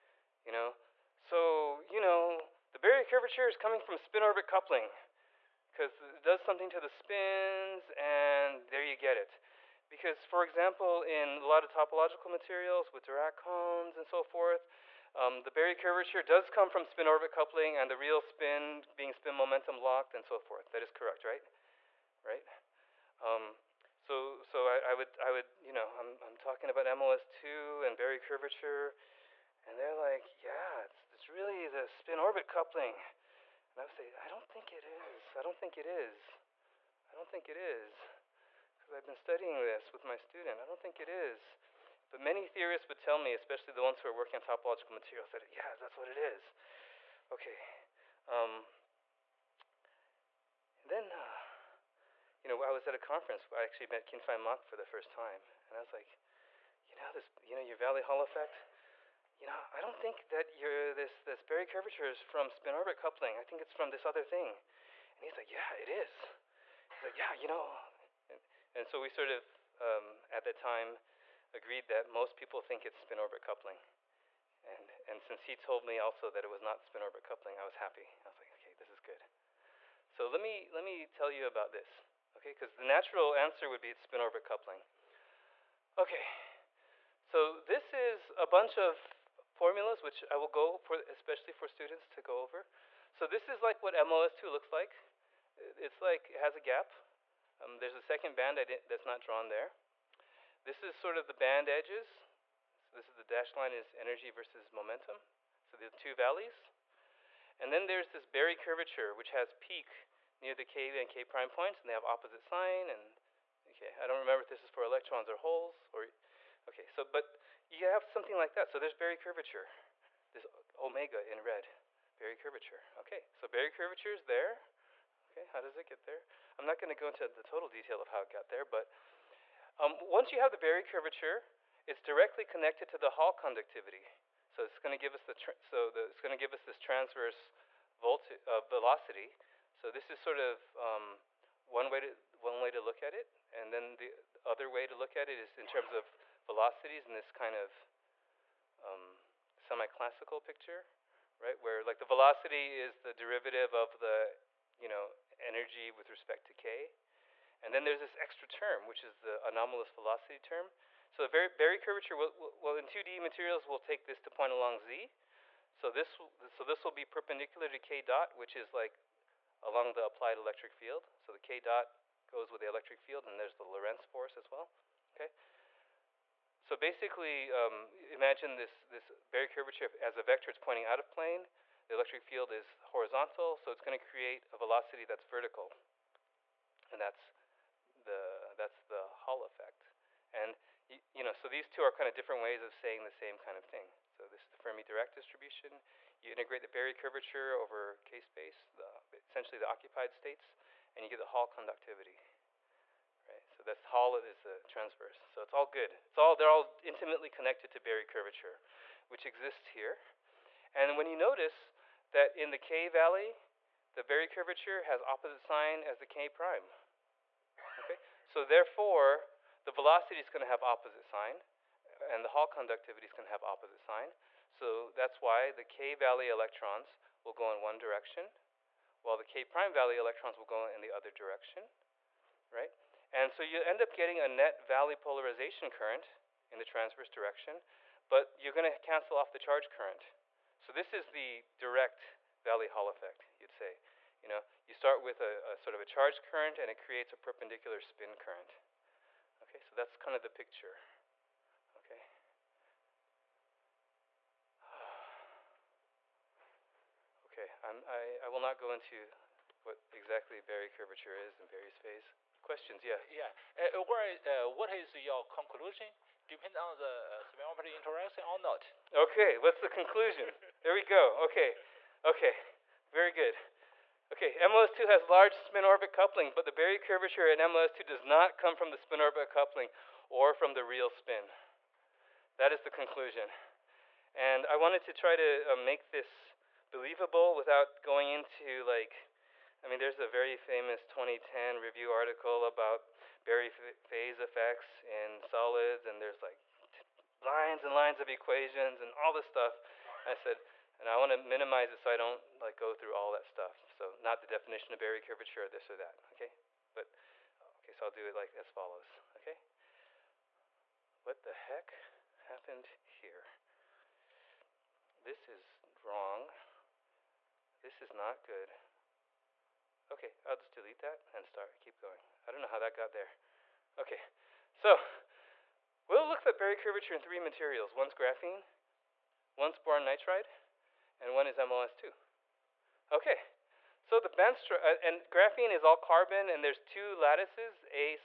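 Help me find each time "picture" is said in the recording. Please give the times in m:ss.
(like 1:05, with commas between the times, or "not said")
2:30, 4:10.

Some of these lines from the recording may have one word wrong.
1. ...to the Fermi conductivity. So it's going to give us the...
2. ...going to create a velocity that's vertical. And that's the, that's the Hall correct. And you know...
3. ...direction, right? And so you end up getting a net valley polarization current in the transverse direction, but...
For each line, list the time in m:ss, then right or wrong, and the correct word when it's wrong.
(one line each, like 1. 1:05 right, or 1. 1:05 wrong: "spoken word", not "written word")
1. 2:12 wrong: "Hall", not "Fermi"
2. 3:03 wrong: "effect", not "correct"
3. 3:51 right.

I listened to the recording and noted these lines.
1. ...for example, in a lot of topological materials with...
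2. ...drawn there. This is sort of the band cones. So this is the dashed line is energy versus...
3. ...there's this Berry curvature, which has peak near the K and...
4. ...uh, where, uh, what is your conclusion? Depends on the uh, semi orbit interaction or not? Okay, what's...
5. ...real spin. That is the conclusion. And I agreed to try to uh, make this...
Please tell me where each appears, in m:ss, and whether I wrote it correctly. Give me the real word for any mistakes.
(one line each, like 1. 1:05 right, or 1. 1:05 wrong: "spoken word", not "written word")
1. 0:10 right
2. 1:39 wrong: "edges", not "cones"
3. 1:47 right
4. 4:23 right
5. 4:40 wrong: "wanted", not "agreed".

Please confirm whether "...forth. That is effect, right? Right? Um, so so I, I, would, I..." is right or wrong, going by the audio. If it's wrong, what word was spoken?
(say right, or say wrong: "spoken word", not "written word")
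wrong: "correct", not "effect".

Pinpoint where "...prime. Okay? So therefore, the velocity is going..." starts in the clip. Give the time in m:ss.
3:36.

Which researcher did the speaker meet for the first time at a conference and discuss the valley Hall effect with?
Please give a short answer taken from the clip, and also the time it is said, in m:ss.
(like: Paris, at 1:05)
Kin Fai Mak, at 0:54.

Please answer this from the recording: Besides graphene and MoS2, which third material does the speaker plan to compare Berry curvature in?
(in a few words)
boron nitride.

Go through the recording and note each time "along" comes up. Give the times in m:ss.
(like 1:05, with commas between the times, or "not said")
2:44, 2:49.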